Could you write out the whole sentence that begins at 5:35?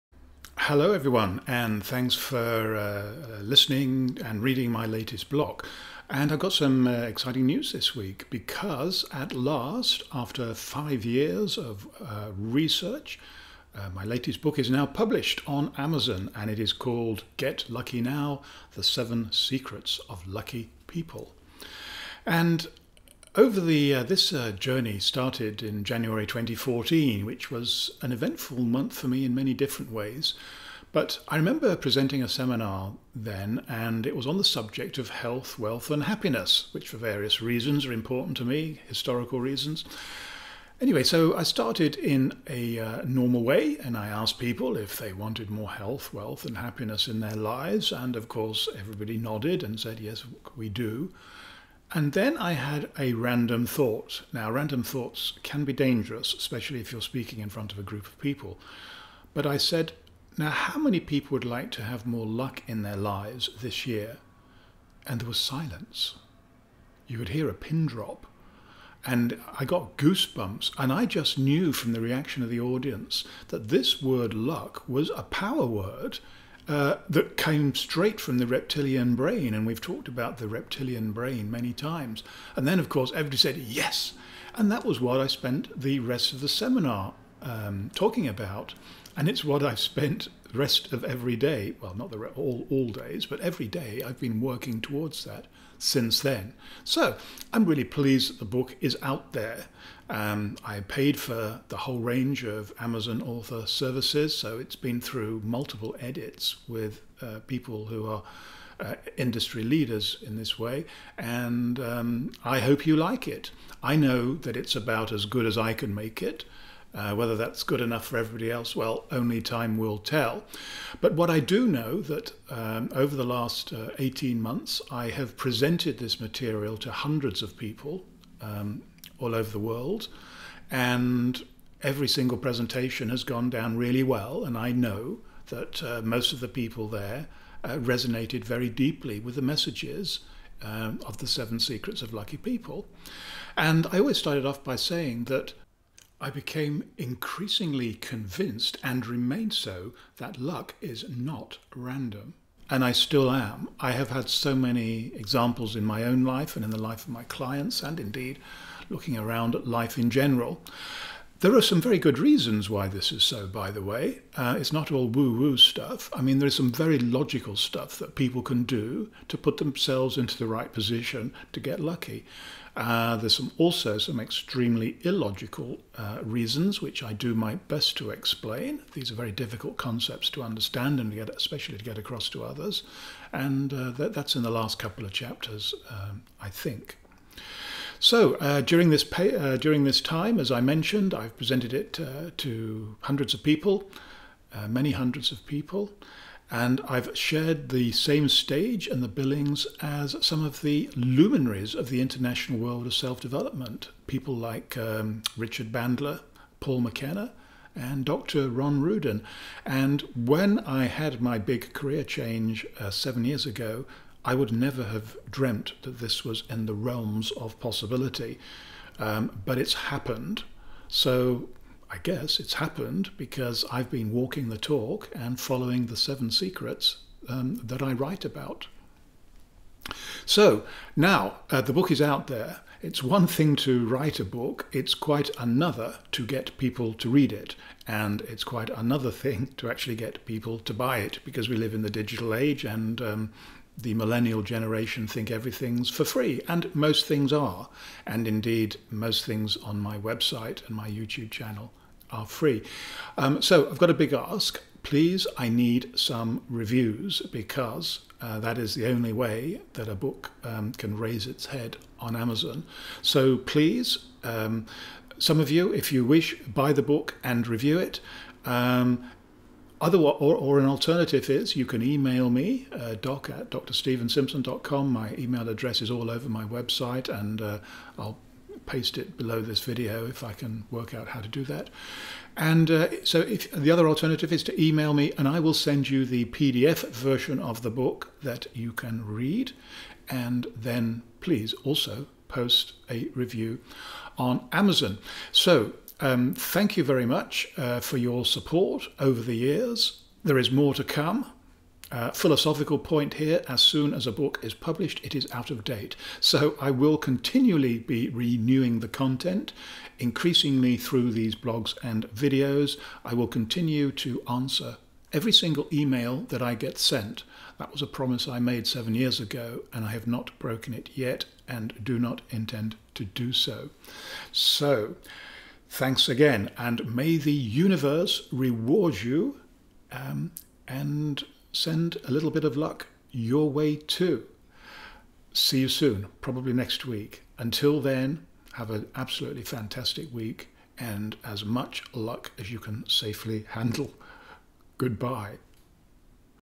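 See you soon, probably next week.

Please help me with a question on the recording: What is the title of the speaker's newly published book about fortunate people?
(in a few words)
Get Lucky Now.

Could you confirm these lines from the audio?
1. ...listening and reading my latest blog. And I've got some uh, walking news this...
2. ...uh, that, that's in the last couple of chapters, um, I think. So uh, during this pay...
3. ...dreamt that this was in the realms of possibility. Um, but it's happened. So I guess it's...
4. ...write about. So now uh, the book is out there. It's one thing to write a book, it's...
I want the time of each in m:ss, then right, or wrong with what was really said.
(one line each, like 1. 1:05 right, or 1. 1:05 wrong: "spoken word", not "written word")
1. 0:03 wrong: "exciting", not "walking"
2. 3:03 right
3. 3:35 right
4. 3:47 right.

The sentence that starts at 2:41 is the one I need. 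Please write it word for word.
There are some very good reasons why this is so, by the way.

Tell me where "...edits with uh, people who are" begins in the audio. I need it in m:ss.
1:45.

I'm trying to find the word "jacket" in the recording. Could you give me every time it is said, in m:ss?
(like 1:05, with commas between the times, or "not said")
not said.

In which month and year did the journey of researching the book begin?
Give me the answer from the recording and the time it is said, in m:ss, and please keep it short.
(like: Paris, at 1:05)
January 2014, at 0:25.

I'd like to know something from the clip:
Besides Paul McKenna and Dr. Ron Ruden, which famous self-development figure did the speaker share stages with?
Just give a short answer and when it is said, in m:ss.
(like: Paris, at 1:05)
Richard Bandler, at 3:25.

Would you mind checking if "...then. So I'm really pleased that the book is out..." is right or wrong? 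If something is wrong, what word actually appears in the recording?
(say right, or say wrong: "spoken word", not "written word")
right.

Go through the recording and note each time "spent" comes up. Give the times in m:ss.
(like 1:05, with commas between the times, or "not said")
1:25, 1:29.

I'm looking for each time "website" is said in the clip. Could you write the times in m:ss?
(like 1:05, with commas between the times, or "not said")
4:09, 4:36.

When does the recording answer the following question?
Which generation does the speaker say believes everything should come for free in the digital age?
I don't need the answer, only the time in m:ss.
4:03.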